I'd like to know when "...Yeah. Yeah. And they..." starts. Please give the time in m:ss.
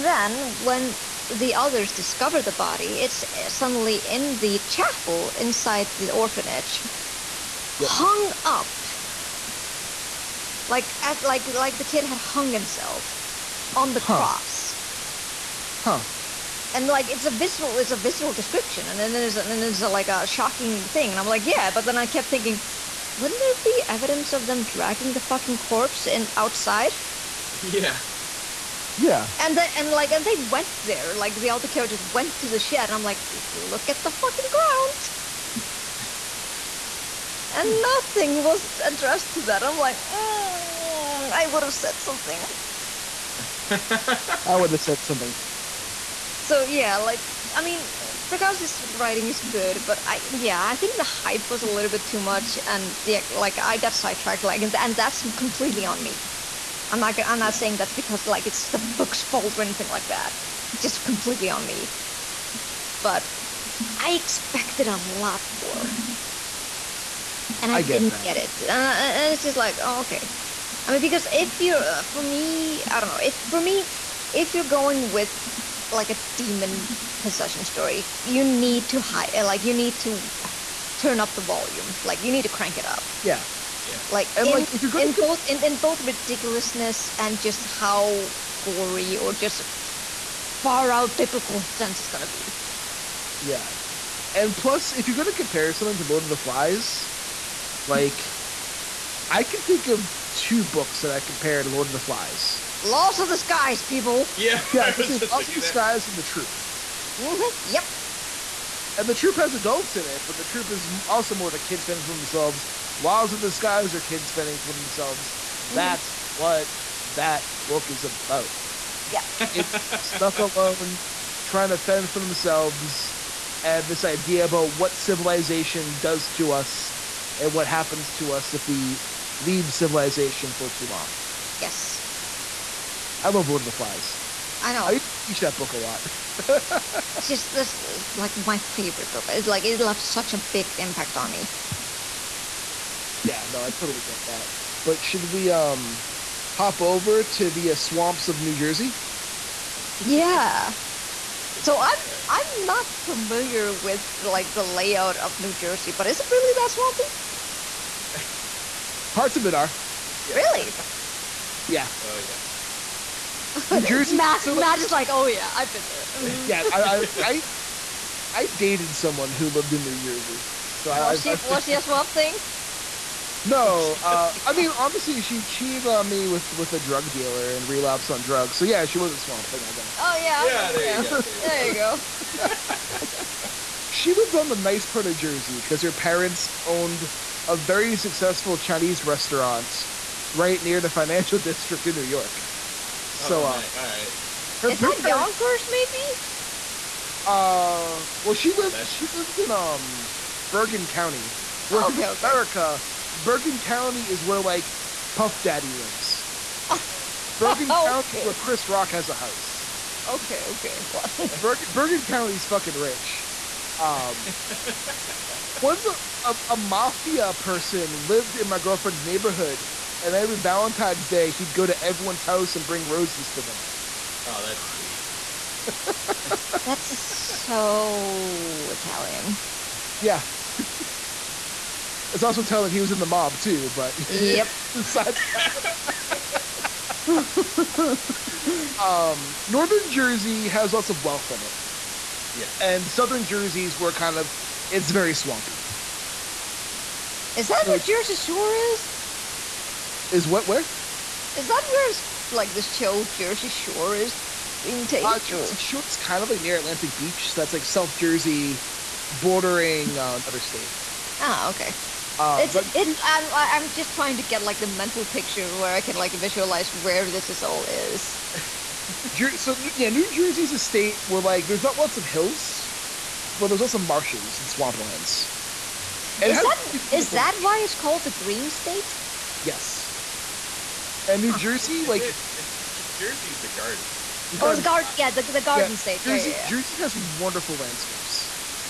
0:27.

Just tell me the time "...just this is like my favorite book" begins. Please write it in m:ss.
2:17.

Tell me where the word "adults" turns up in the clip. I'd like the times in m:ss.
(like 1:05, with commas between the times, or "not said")
1:49.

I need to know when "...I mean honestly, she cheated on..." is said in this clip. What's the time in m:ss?
2:54.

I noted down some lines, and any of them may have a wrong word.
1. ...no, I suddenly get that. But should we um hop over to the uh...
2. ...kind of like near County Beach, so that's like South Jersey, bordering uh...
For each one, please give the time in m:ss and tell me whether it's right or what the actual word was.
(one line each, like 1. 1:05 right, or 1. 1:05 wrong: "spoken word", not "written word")
1. 2:23 wrong: "totally", not "suddenly"
2. 4:15 wrong: "Atlantic", not "County".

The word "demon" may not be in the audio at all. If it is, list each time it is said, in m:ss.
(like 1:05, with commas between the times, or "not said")
1:16.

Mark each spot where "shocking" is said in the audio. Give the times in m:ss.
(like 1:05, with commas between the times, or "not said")
0:20.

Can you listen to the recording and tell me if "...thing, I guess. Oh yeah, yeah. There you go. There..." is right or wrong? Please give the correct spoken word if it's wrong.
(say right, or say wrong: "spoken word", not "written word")
right.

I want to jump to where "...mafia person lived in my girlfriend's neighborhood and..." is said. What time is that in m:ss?
3:36.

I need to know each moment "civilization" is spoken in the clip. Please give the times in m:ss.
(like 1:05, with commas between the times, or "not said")
2:04, 2:09.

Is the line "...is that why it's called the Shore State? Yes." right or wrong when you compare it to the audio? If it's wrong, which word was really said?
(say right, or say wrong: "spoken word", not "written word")
wrong: "Green", not "Shore".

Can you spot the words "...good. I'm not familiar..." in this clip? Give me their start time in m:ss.
2:32.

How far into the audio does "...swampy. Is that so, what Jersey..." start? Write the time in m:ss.
4:05.